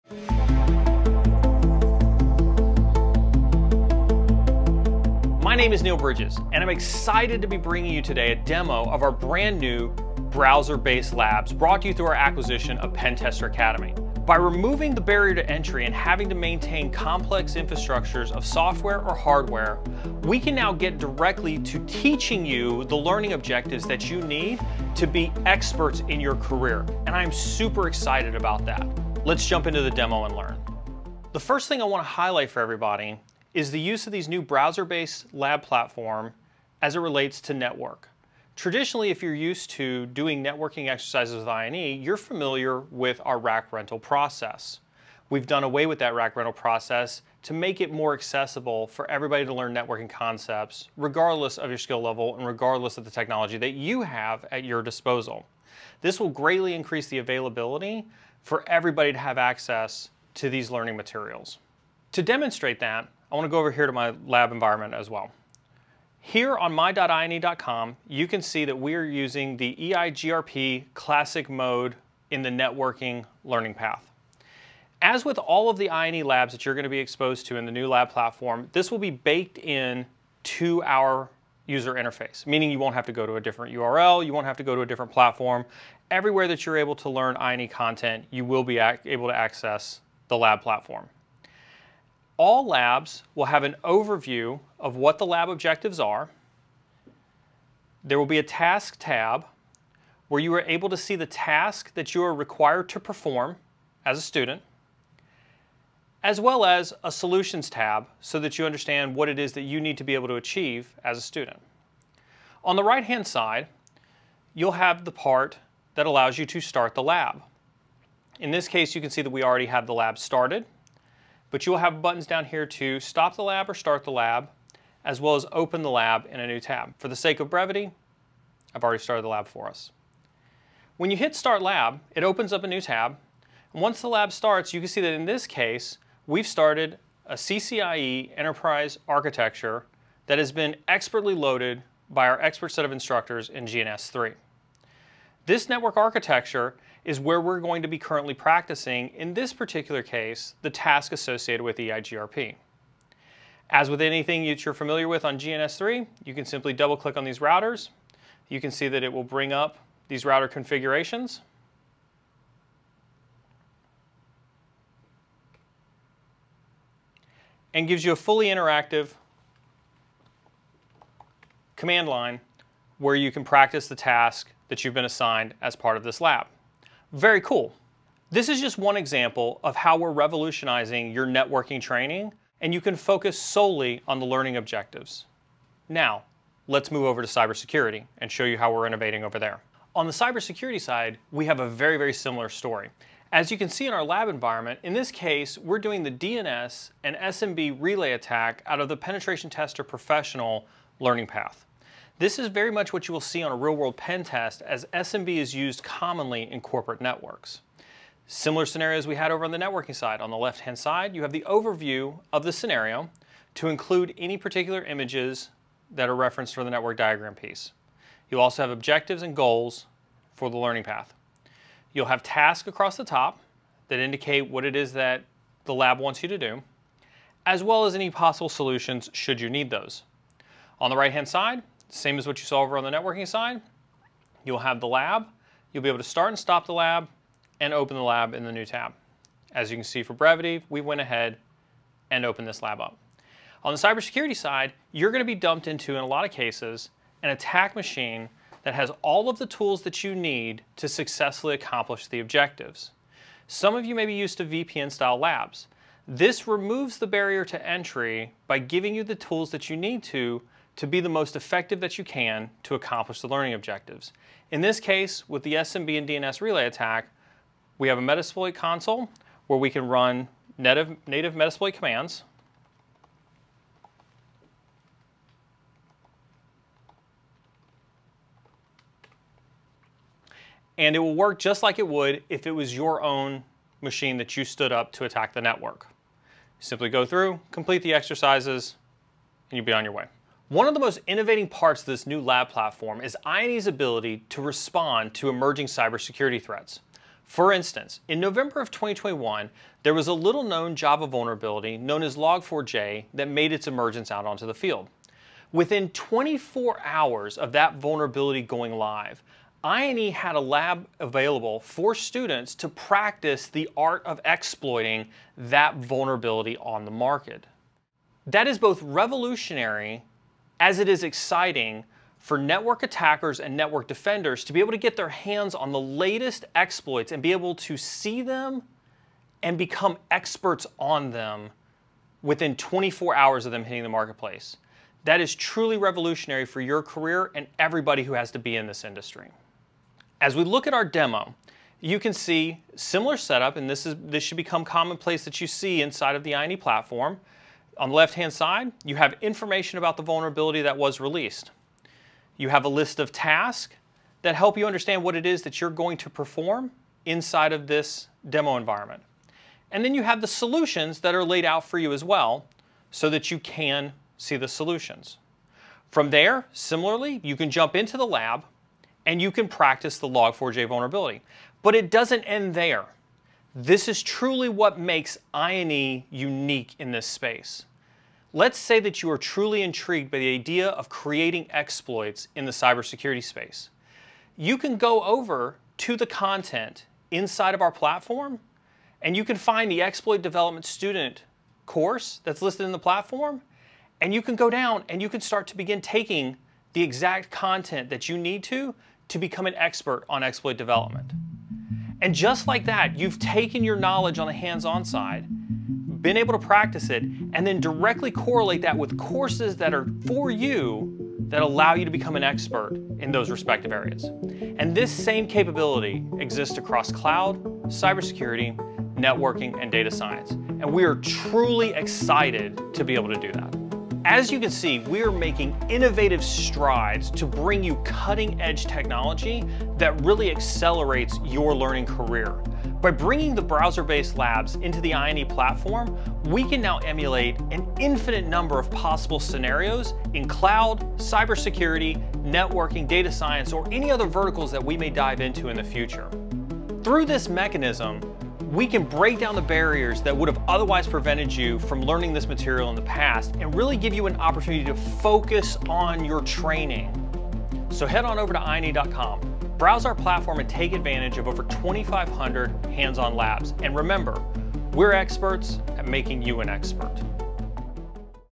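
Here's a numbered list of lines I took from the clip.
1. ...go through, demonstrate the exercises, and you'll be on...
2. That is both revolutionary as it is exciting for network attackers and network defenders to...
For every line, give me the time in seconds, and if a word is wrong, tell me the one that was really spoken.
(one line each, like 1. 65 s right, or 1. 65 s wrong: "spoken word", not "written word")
1. 286 s wrong: "complete", not "demonstrate"
2. 318 s right.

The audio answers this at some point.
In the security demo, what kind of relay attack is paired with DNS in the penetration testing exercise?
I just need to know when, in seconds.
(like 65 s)
197 s.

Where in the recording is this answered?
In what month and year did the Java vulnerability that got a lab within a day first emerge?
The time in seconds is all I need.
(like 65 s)
298 s.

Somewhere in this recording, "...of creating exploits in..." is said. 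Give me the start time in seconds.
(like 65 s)
380 s.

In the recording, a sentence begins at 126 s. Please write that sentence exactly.
For the sake of brevity, I've already started the lab for us.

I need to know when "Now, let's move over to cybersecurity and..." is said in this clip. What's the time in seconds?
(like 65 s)
185 s.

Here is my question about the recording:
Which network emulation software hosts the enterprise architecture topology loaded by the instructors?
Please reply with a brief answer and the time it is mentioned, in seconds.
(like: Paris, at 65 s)
GNS3, at 143 s.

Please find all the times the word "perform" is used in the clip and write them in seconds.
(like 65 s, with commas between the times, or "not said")
102 s, 356 s.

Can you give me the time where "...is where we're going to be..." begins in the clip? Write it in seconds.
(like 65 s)
147 s.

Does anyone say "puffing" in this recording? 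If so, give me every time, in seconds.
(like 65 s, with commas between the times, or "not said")
not said.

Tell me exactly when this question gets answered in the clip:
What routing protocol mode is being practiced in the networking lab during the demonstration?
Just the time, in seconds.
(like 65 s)
69 s.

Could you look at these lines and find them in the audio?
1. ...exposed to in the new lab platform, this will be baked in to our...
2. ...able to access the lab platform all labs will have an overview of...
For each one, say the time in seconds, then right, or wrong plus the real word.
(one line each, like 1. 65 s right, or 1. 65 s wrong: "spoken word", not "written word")
1. 76 s right
2. 88 s right.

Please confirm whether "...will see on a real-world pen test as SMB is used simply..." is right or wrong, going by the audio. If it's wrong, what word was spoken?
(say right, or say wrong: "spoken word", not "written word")
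wrong: "commonly", not "simply".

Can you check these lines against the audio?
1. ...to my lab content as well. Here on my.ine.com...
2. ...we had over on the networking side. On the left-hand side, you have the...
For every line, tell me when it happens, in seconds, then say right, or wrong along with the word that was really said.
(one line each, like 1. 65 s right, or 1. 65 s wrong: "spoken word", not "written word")
1. 63 s wrong: "environment", not "content"
2. 209 s right.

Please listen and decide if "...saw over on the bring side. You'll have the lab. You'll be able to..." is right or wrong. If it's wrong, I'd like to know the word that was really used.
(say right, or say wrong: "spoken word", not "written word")
wrong: "networking", not "bring".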